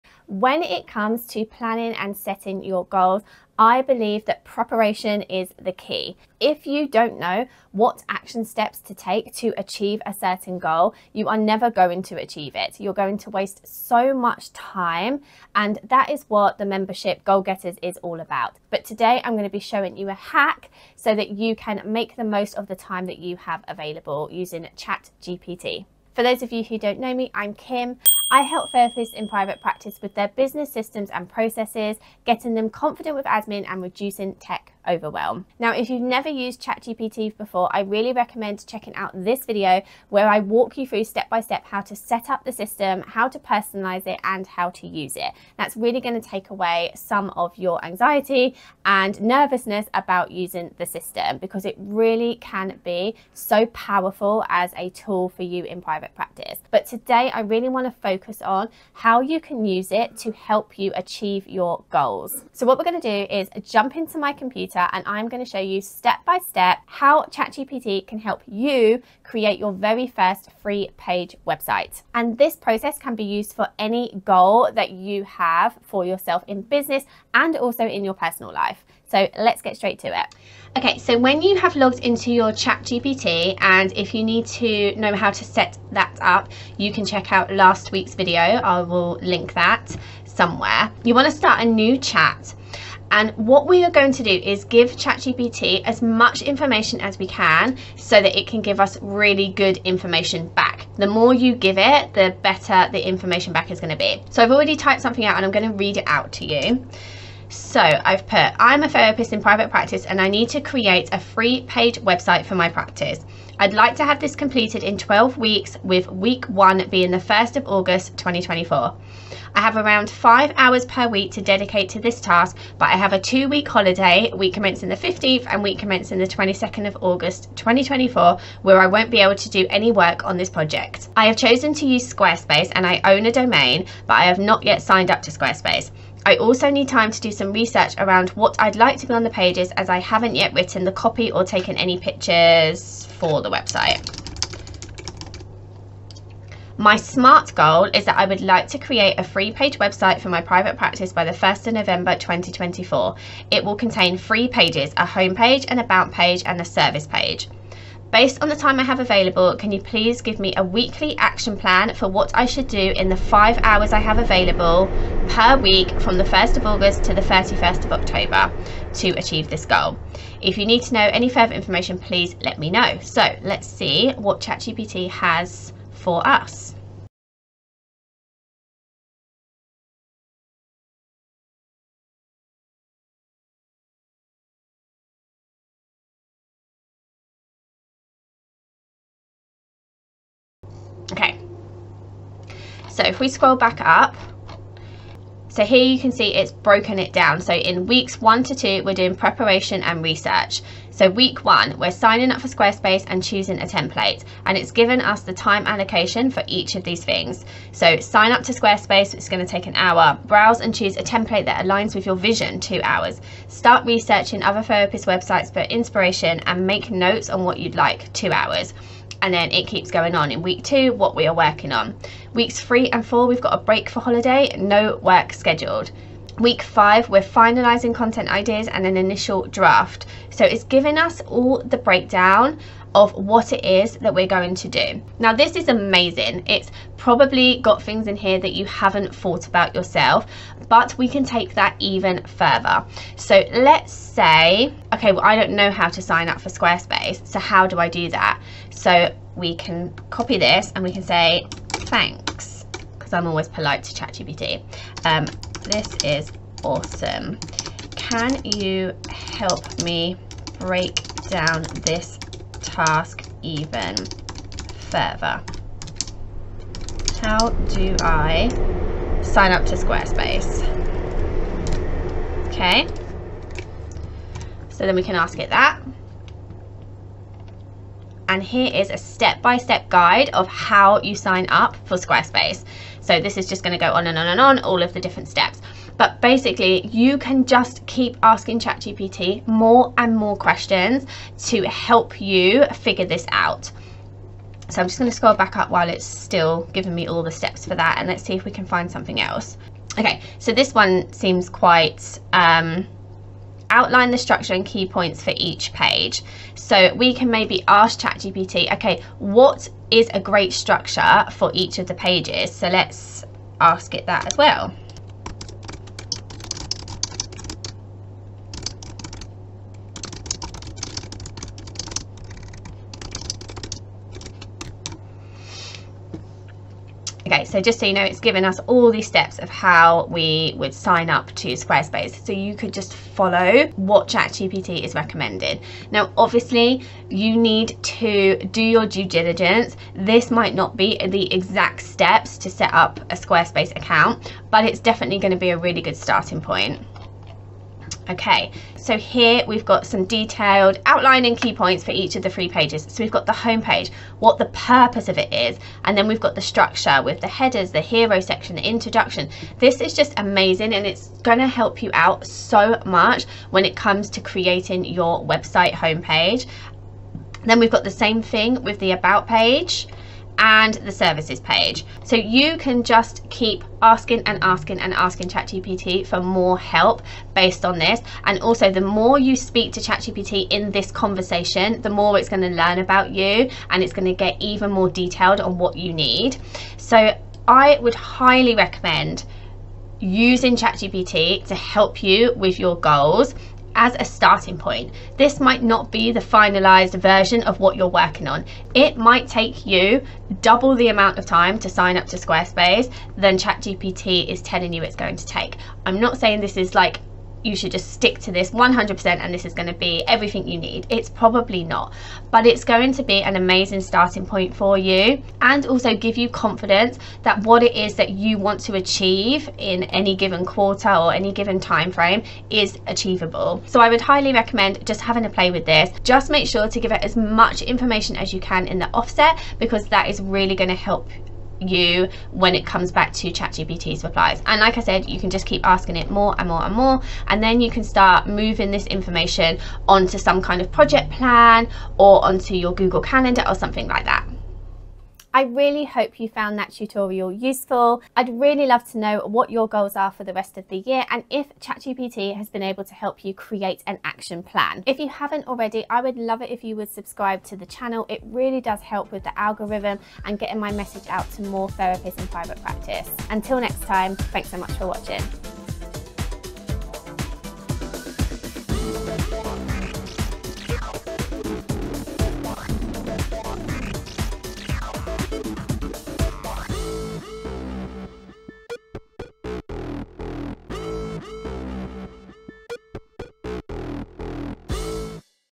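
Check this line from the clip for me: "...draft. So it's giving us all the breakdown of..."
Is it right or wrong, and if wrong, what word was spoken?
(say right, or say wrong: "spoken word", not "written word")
right.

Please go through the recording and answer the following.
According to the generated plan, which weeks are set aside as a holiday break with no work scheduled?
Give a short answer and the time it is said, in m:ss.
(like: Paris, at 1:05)
Weeks 3 and 4, at 3:42.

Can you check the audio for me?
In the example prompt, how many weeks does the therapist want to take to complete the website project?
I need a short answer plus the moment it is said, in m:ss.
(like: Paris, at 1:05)
12, at 1:54.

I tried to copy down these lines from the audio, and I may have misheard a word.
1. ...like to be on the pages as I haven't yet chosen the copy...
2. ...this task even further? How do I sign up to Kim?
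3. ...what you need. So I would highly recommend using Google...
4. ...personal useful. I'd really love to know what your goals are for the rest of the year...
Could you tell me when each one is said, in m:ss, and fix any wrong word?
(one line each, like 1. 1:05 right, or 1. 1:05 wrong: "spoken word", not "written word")
1. 2:18 wrong: "written", not "chosen"
2. 4:21 wrong: "Squarespace", not "Kim"
3. 6:25 wrong: "ChatGPT", not "Google"
4. 7:26 wrong: "tutorial", not "personal".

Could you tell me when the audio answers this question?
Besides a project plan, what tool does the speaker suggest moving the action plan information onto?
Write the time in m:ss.
7:22.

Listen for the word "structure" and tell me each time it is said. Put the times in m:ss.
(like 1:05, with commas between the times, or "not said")
5:04, 5:10, 5:56.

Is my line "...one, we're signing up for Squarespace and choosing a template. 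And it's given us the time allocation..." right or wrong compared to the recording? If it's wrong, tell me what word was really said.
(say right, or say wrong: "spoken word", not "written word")
right.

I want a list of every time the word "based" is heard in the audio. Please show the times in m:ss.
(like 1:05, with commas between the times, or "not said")
2:38, 6:17.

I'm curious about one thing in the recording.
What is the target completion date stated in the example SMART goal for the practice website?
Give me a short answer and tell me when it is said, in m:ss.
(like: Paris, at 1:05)
1st of November 2024, at 2:31.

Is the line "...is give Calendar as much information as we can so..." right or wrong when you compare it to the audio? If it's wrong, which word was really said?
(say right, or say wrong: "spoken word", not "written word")
wrong: "ChatGPT", not "Calendar".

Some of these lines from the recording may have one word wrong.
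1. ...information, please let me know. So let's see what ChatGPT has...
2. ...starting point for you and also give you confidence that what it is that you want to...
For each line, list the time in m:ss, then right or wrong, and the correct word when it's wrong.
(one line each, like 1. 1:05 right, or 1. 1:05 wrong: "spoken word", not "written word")
1. 2:51 right
2. 6:53 right.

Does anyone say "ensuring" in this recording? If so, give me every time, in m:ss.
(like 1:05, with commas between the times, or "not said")
not said.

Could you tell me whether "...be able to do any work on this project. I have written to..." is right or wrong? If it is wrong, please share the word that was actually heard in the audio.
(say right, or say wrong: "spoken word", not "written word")
wrong: "chosen", not "written".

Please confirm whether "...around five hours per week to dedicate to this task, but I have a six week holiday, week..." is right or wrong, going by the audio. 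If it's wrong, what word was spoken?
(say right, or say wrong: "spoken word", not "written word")
wrong: "two", not "six".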